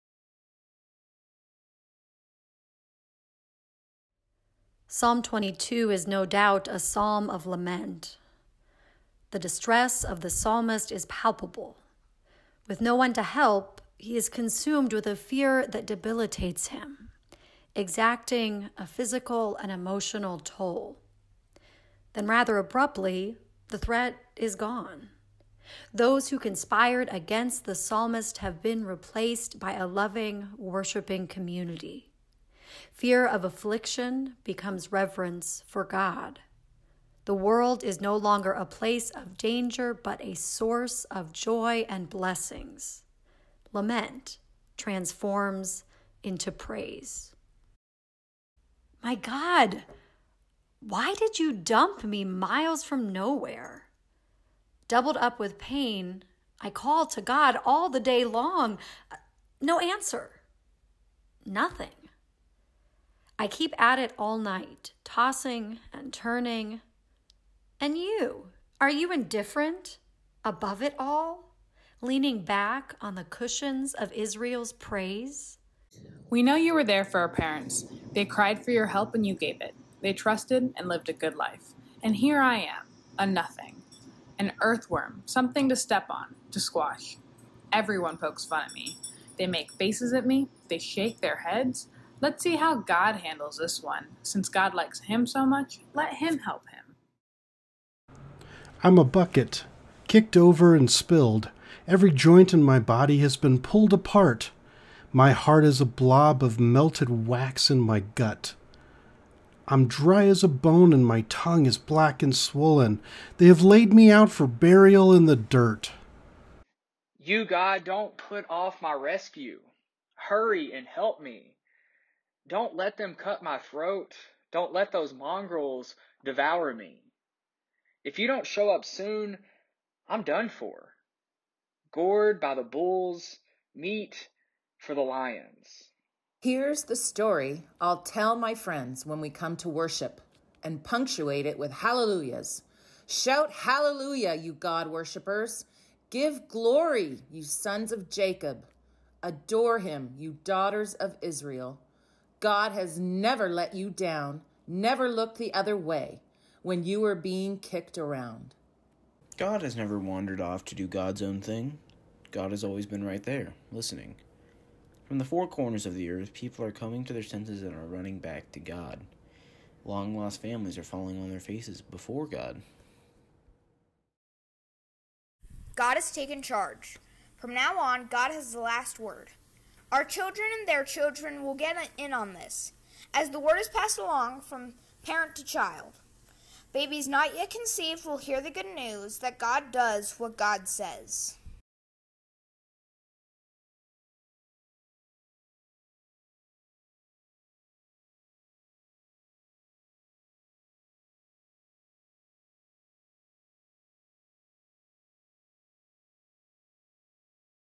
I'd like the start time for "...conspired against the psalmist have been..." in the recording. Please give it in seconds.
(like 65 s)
26 s.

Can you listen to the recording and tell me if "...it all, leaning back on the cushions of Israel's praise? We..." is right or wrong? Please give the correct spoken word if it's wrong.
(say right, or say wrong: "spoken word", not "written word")
right.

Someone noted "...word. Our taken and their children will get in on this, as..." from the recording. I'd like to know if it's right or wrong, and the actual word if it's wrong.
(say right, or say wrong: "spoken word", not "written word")
wrong: "children", not "taken".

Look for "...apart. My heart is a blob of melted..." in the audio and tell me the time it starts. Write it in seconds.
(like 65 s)
103 s.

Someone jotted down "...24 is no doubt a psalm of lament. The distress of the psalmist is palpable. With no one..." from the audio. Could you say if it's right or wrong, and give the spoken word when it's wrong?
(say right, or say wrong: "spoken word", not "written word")
wrong: "22", not "24".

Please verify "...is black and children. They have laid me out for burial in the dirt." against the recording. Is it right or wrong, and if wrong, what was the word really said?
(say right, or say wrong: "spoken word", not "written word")
wrong: "swollen", not "children".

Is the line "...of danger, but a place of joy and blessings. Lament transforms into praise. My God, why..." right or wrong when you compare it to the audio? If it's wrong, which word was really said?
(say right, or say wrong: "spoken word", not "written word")
wrong: "source", not "place".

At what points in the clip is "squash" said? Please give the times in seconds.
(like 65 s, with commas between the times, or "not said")
86 s.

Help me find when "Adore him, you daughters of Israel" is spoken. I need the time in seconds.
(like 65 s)
149 s.